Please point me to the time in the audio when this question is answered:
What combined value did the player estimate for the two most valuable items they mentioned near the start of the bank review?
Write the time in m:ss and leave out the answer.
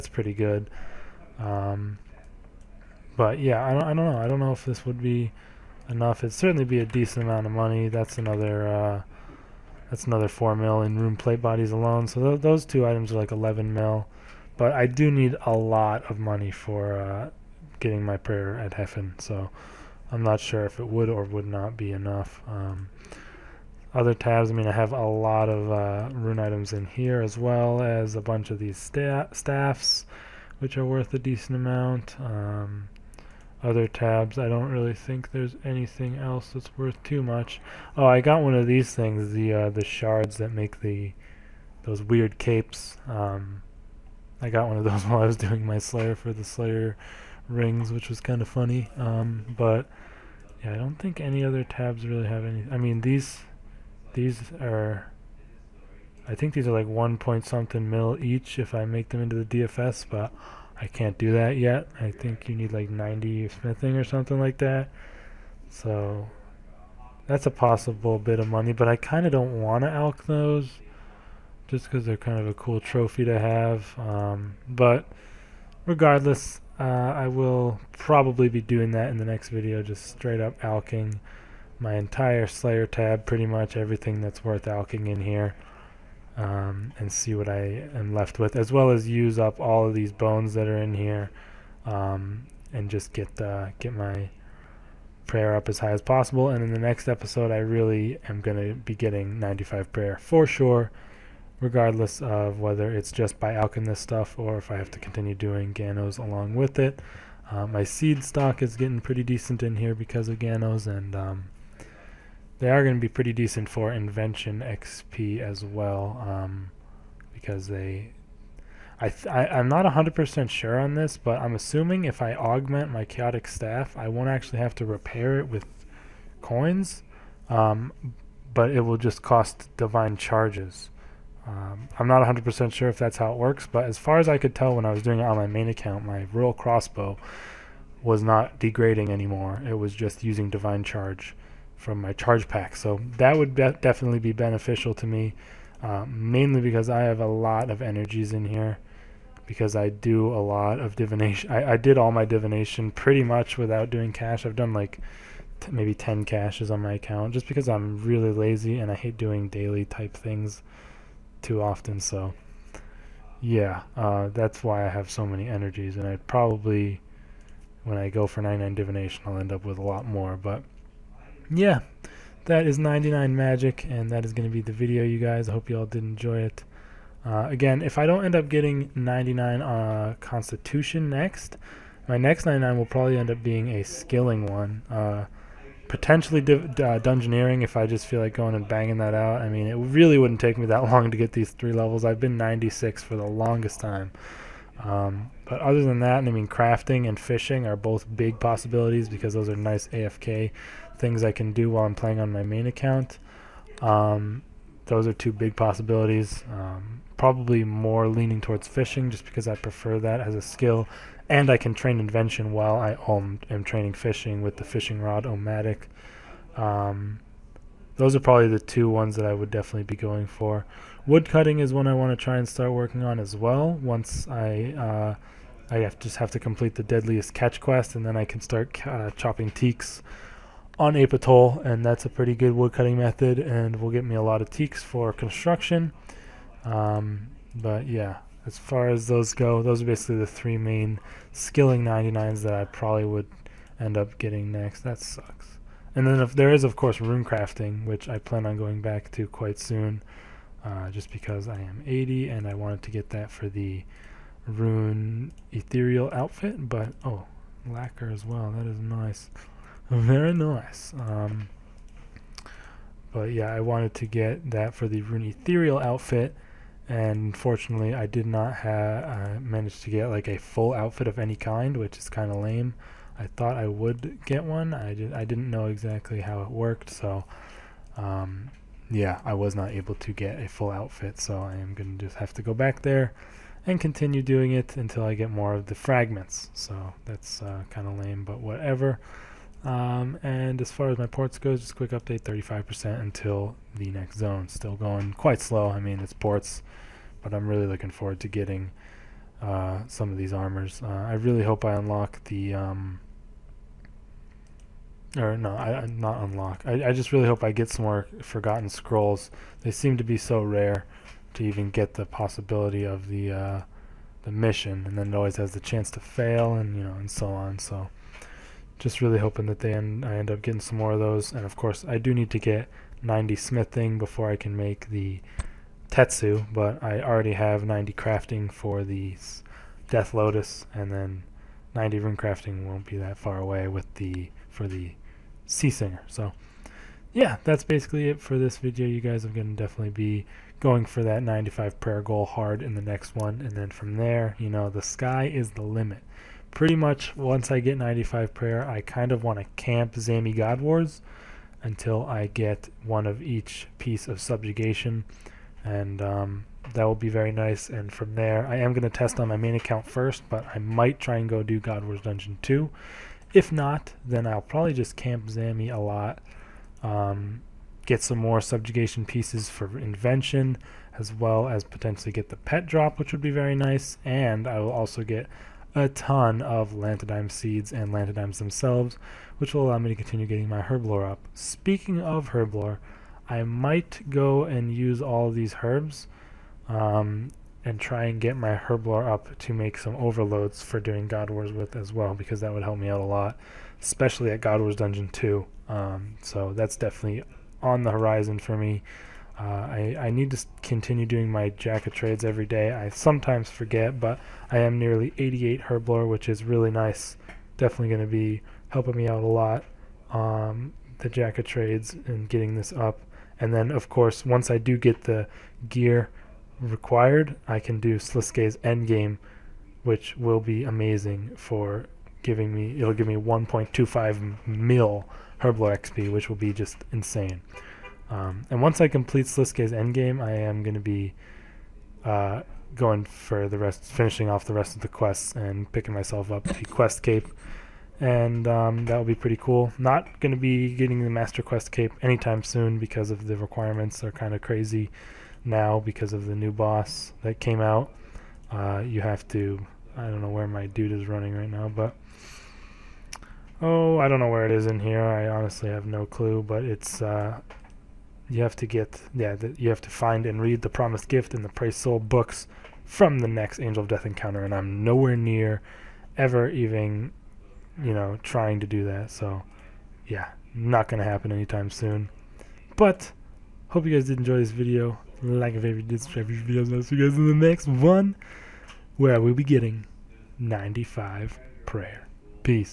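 0:13.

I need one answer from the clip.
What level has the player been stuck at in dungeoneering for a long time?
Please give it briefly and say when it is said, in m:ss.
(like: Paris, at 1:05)
96, at 3:12.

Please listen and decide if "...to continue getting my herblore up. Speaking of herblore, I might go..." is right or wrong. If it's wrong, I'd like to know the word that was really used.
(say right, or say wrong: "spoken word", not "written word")
right.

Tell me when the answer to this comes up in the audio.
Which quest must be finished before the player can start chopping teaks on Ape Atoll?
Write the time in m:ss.
3:46.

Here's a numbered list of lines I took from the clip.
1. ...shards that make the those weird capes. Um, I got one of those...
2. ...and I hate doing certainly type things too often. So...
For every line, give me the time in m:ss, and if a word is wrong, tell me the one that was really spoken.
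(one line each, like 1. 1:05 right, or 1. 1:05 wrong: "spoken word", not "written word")
1. 0:39 right
2. 2:38 wrong: "daily", not "certainly".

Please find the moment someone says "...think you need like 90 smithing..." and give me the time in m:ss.
1:02.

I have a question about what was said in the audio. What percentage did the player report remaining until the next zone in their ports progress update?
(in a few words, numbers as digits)
35%.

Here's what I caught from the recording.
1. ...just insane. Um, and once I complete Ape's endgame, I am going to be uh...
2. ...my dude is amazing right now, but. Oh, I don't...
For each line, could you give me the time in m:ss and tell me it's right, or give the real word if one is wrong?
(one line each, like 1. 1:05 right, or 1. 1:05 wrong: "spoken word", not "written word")
1. 7:06 wrong: "Sliske", not "Ape"
2. 7:30 wrong: "running", not "amazing".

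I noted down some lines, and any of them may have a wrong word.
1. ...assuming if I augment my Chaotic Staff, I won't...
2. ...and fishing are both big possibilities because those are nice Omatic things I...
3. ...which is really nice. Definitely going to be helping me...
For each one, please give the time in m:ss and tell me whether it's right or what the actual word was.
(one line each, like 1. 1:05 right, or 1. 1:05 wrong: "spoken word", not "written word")
1. 2:01 right
2. 3:17 wrong: "AFK", not "Omatic"
3. 6:46 right.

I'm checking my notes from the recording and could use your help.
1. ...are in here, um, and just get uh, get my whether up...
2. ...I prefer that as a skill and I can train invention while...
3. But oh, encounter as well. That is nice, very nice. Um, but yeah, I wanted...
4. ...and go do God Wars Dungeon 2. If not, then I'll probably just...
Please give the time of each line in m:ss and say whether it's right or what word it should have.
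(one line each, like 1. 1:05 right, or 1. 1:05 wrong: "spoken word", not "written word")
1. 1:30 wrong: "prayer", not "whether"
2. 3:29 right
3. 4:16 wrong: "lacquer", not "encounter"
4. 6:01 right.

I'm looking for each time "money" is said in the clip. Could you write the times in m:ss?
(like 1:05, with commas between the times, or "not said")
0:07, 0:16, 1:08.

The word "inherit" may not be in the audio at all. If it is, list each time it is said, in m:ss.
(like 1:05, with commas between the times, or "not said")
not said.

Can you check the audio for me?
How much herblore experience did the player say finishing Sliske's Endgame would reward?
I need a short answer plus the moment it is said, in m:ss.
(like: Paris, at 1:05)
1.25 mil, at 7:03.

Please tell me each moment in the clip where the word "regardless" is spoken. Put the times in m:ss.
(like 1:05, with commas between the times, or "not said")
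1:15, 1:41.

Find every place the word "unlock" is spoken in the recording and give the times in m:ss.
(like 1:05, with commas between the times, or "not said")
5:01, 5:06.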